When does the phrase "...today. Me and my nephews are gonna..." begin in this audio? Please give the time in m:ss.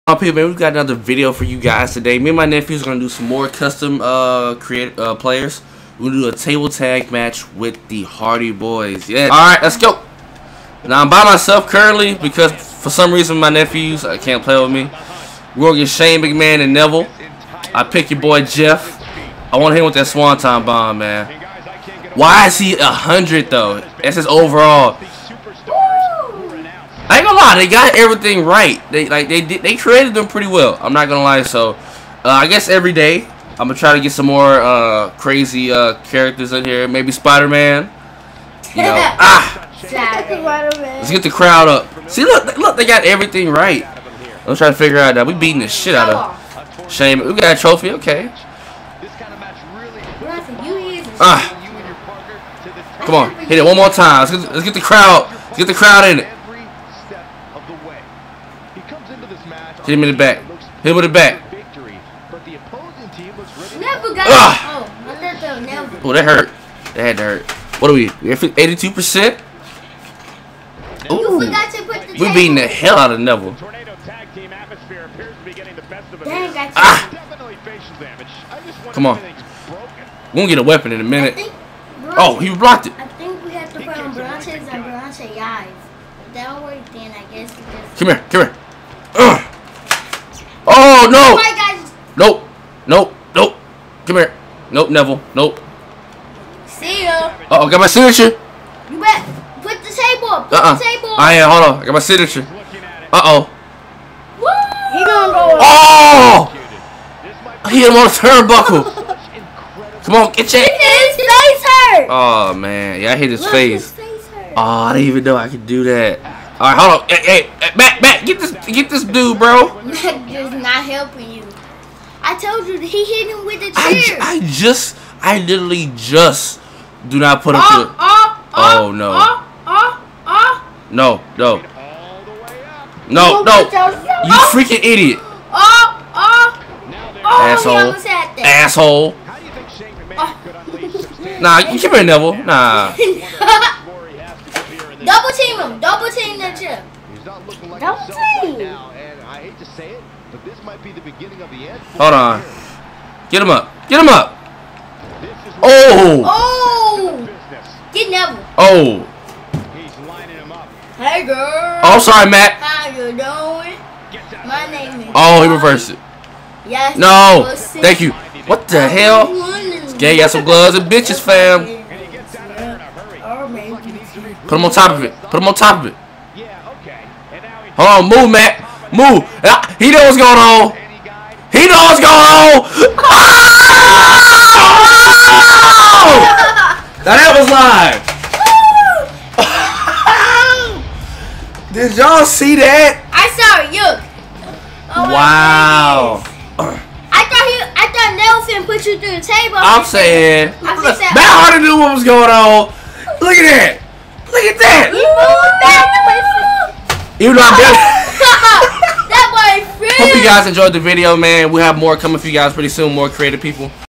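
0:01.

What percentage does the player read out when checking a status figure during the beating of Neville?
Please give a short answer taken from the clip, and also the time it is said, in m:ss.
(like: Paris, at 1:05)
82%, at 1:08.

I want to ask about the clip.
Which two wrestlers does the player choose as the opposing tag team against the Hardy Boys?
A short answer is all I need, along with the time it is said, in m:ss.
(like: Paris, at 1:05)
Shane McMahon and Neville, at 0:15.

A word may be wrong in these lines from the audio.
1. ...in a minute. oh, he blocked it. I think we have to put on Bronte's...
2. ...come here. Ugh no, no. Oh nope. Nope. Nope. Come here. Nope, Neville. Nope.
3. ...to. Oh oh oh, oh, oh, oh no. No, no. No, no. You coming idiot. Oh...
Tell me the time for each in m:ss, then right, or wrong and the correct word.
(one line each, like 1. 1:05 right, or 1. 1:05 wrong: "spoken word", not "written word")
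1. 1:20 right
2. 1:28 right
3. 2:07 wrong: "freaking", not "coming".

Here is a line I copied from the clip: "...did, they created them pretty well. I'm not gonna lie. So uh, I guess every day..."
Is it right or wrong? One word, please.
right.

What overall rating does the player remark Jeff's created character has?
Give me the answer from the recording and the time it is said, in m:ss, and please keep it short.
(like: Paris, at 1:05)
100, at 0:22.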